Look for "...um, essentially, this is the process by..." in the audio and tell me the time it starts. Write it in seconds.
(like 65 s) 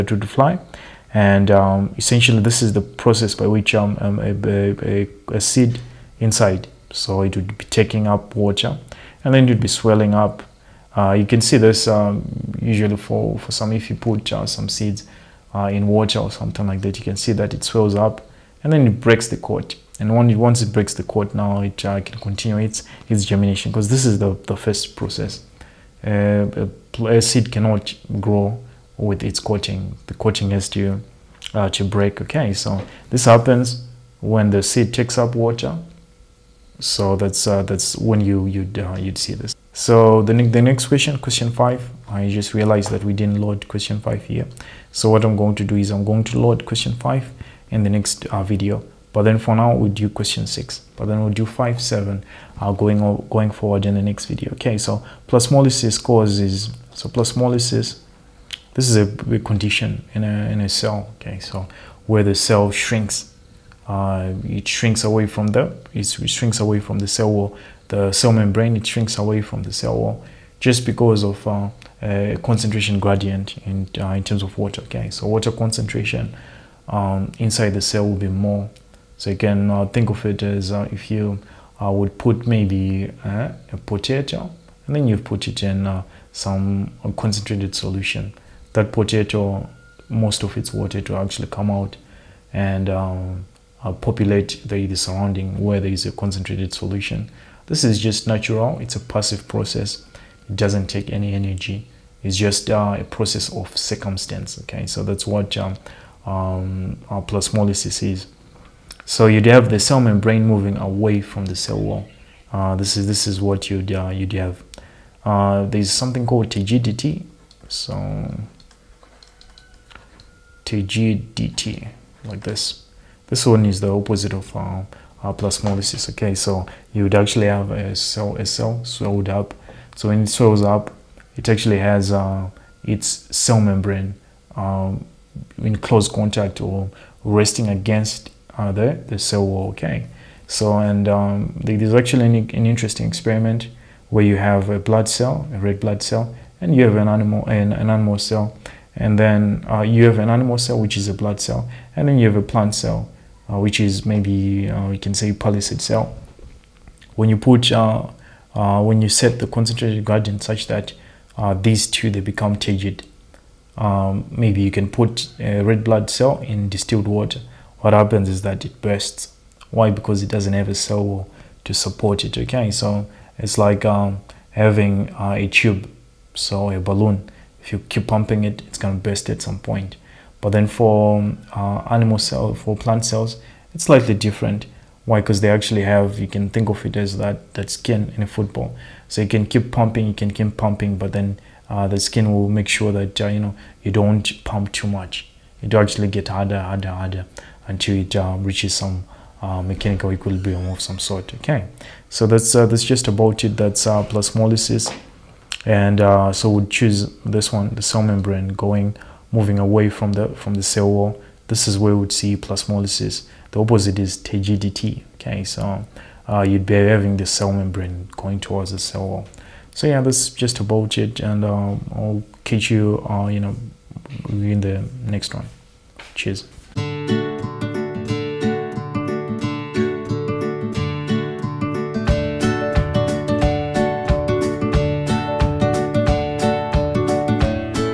1 s.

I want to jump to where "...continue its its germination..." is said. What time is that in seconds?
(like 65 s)
22 s.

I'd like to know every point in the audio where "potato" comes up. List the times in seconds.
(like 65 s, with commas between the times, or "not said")
83 s, 88 s.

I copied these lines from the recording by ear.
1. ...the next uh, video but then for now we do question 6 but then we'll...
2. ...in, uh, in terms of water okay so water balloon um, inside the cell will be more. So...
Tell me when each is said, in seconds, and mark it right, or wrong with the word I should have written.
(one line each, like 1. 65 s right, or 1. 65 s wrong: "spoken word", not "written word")
1. 47 s right
2. 73 s wrong: "concentration", not "balloon".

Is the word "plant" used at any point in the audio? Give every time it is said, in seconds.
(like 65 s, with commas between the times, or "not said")
152 s, 182 s.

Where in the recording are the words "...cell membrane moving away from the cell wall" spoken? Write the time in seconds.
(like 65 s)
109 s.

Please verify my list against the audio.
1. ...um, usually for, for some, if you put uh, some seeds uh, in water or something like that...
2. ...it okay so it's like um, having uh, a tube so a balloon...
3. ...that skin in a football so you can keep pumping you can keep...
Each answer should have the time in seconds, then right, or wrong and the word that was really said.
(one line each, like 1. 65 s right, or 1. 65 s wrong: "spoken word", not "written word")
1. 11 s right
2. 172 s right
3. 187 s right.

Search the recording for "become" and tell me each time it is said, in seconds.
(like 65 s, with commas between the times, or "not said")
162 s.